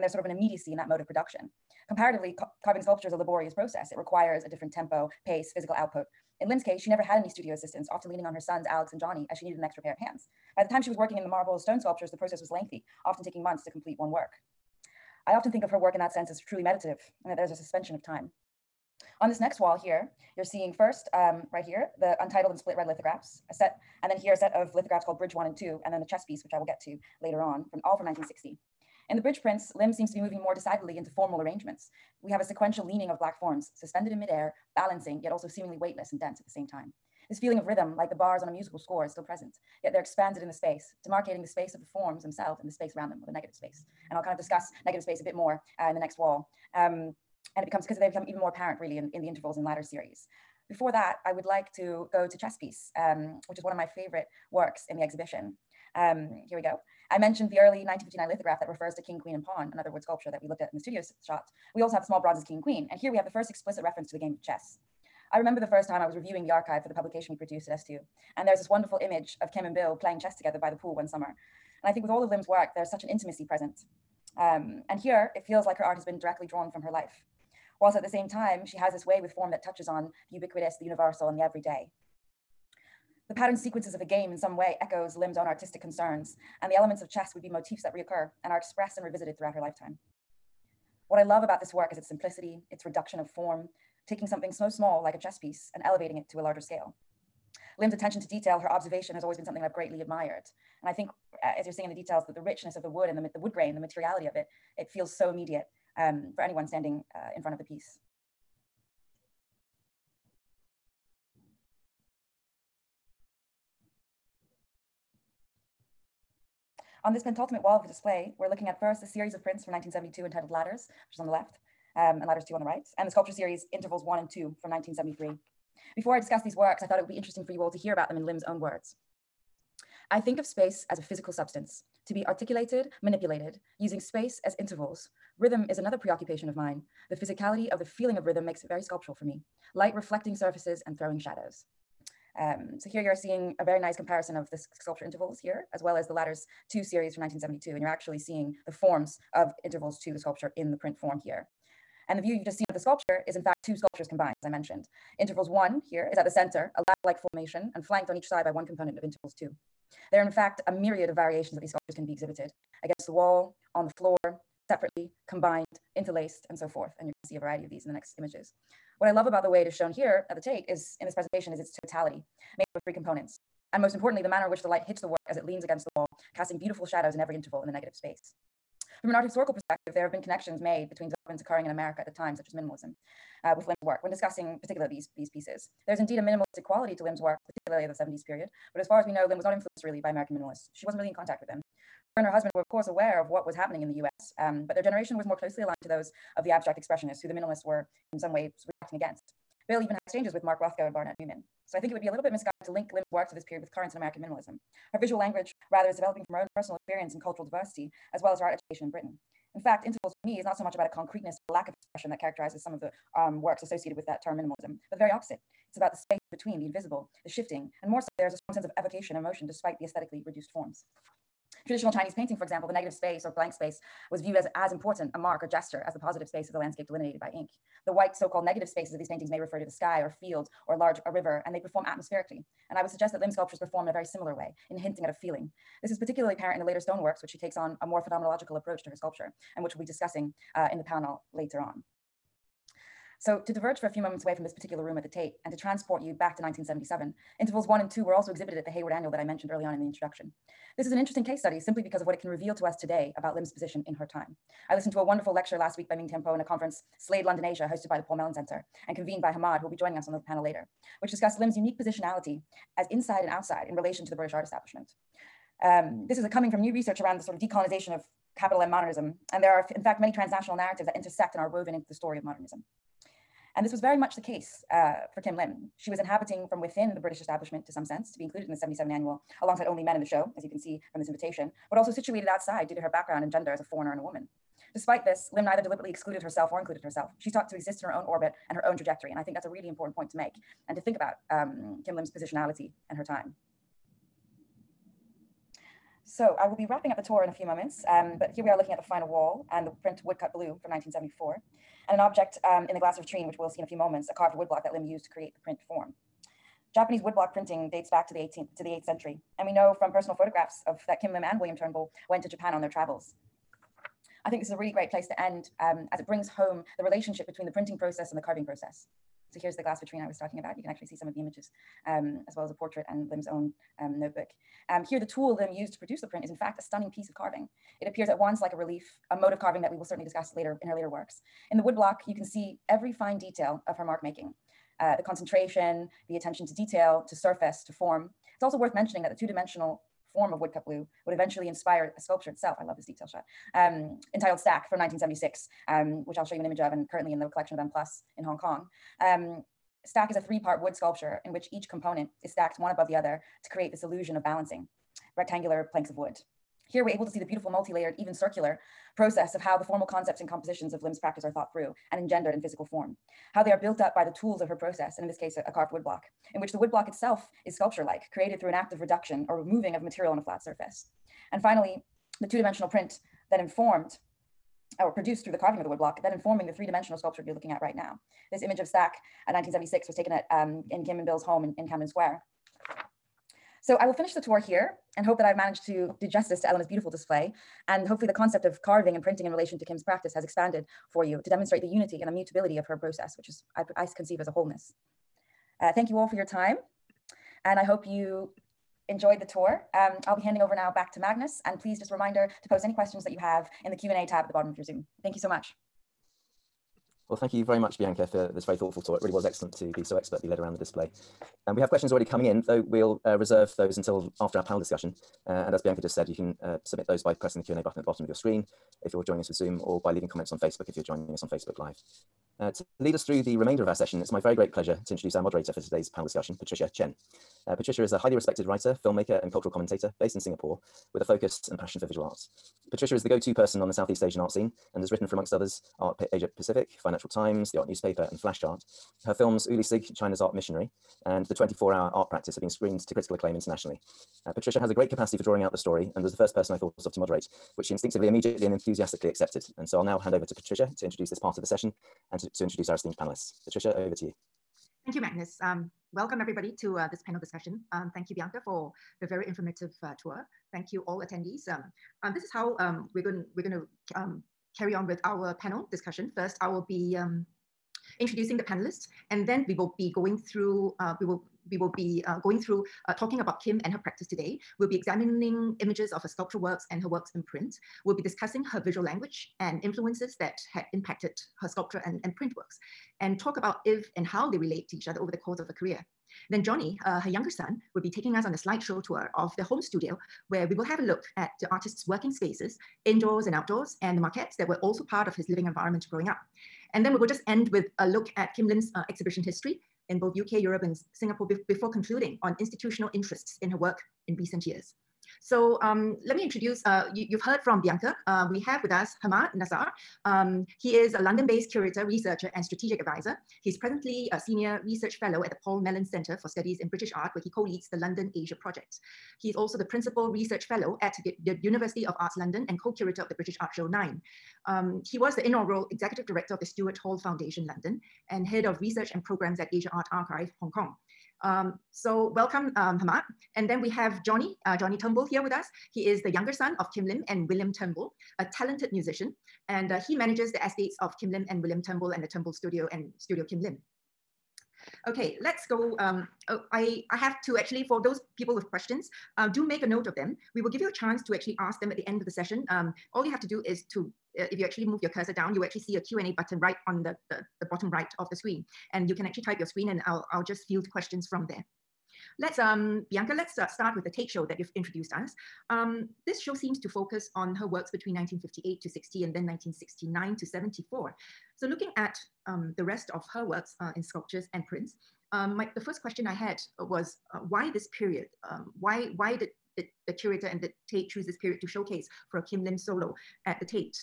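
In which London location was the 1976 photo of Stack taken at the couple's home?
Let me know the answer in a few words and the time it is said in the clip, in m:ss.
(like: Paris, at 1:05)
Camden Square, at 6:21.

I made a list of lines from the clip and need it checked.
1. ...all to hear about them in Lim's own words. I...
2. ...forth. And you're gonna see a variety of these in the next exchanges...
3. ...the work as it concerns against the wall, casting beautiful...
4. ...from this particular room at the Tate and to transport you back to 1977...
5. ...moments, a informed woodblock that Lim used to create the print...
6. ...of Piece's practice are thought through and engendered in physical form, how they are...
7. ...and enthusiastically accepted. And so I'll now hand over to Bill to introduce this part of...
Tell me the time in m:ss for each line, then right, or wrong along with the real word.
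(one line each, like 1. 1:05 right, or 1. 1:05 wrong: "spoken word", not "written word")
1. 2:07 right
2. 2:46 wrong: "images", not "exchanges"
3. 2:55 wrong: "leans", not "concerns"
4. 4:04 right
5. 5:03 wrong: "carved", not "informed"
6. 6:00 wrong: "Lim", not "Piece"
7. 7:28 wrong: "Patricia", not "Bill".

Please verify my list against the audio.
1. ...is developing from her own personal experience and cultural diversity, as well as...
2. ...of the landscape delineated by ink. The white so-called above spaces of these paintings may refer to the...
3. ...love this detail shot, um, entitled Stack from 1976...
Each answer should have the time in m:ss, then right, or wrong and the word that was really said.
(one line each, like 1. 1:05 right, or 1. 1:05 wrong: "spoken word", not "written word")
1. 3:25 right
2. 3:46 wrong: "negative", not "above"
3. 5:42 right.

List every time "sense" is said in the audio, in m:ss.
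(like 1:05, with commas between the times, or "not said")
0:16, 3:38, 4:37.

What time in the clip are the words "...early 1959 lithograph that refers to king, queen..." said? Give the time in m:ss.
0:57.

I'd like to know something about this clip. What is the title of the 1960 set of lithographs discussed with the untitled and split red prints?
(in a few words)
Bridge 1 and 2.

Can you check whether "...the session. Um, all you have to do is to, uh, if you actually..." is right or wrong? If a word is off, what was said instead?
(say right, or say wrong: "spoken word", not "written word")
right.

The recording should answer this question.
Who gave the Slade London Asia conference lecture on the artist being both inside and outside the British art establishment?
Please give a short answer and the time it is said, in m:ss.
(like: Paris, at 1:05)
Ming Tiampo, at 4:15.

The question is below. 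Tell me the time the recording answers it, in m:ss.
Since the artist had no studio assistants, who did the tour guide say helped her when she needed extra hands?
0:08.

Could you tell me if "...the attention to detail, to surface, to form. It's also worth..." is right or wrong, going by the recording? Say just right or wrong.
right.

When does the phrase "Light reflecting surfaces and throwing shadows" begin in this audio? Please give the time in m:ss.
2:19.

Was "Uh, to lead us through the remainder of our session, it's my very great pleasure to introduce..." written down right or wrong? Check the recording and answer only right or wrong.
right.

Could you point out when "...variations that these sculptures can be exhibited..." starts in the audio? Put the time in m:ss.
2:41.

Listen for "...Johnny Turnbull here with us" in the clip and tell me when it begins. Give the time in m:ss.
8:54.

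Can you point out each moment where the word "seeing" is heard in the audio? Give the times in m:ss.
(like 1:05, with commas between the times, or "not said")
0:20, 1:41, 2:23, 2:28.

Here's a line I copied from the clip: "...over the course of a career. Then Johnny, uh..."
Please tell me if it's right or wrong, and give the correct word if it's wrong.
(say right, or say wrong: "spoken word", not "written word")
right.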